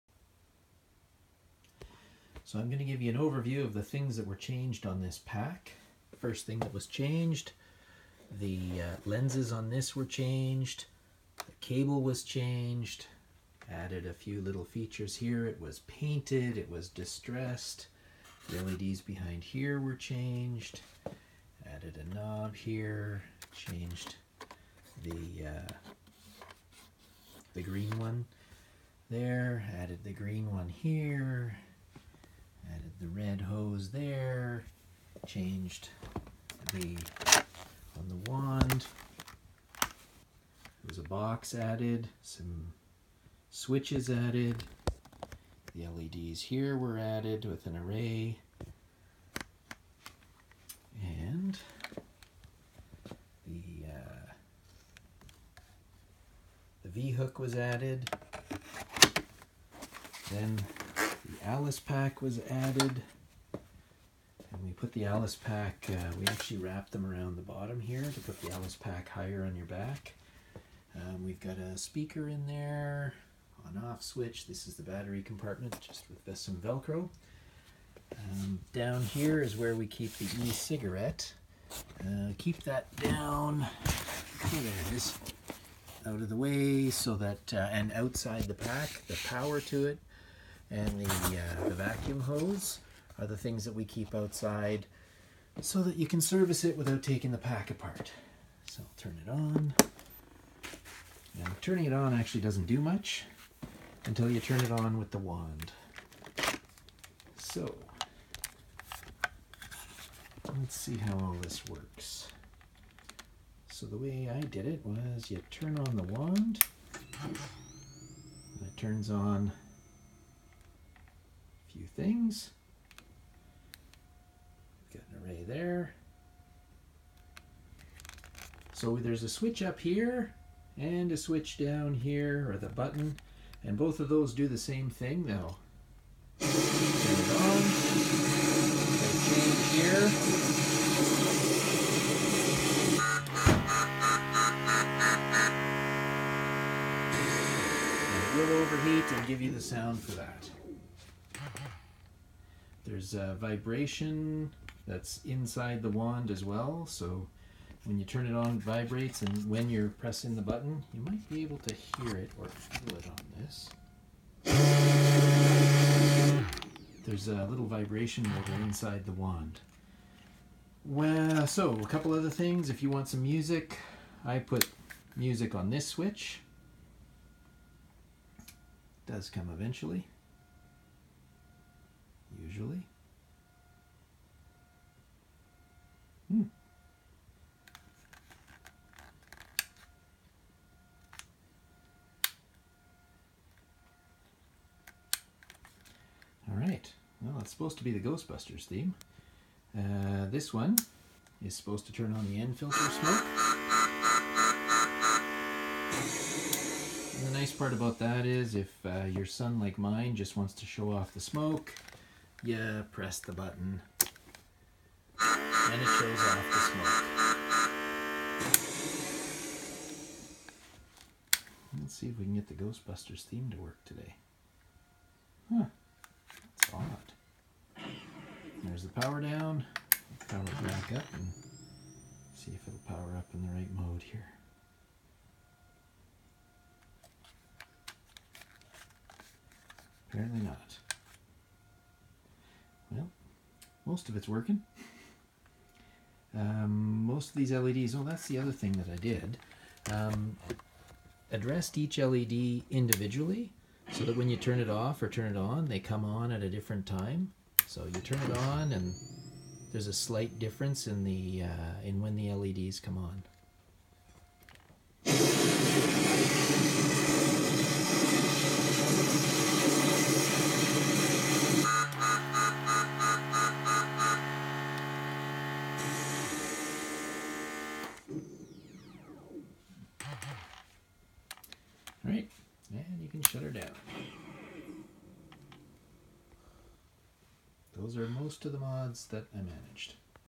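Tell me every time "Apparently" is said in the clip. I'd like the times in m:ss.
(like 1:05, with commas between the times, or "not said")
4:00.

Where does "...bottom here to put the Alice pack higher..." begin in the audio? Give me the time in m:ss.
1:07.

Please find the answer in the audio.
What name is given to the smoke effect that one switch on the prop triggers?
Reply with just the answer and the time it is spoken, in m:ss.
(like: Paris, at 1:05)
N-filter smoke, at 3:22.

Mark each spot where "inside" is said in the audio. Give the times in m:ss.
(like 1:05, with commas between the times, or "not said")
2:35, 2:48.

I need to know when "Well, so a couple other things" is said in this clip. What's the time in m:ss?
2:50.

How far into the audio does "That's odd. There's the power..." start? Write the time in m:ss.
3:46.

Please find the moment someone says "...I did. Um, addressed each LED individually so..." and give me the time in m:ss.
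4:08.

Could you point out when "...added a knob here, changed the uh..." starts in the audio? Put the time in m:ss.
0:21.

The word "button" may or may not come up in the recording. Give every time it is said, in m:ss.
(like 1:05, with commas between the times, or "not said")
2:12, 2:40, 3:33.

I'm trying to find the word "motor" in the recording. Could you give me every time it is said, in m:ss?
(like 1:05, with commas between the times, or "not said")
2:48.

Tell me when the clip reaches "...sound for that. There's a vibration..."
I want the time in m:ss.
2:29.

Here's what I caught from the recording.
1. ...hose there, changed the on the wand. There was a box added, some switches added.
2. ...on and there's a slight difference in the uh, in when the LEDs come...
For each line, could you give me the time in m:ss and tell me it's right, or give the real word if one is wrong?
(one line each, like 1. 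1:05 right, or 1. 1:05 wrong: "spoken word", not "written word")
1. 0:33 right
2. 4:18 right.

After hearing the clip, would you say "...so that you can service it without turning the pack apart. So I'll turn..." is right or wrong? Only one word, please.
wrong.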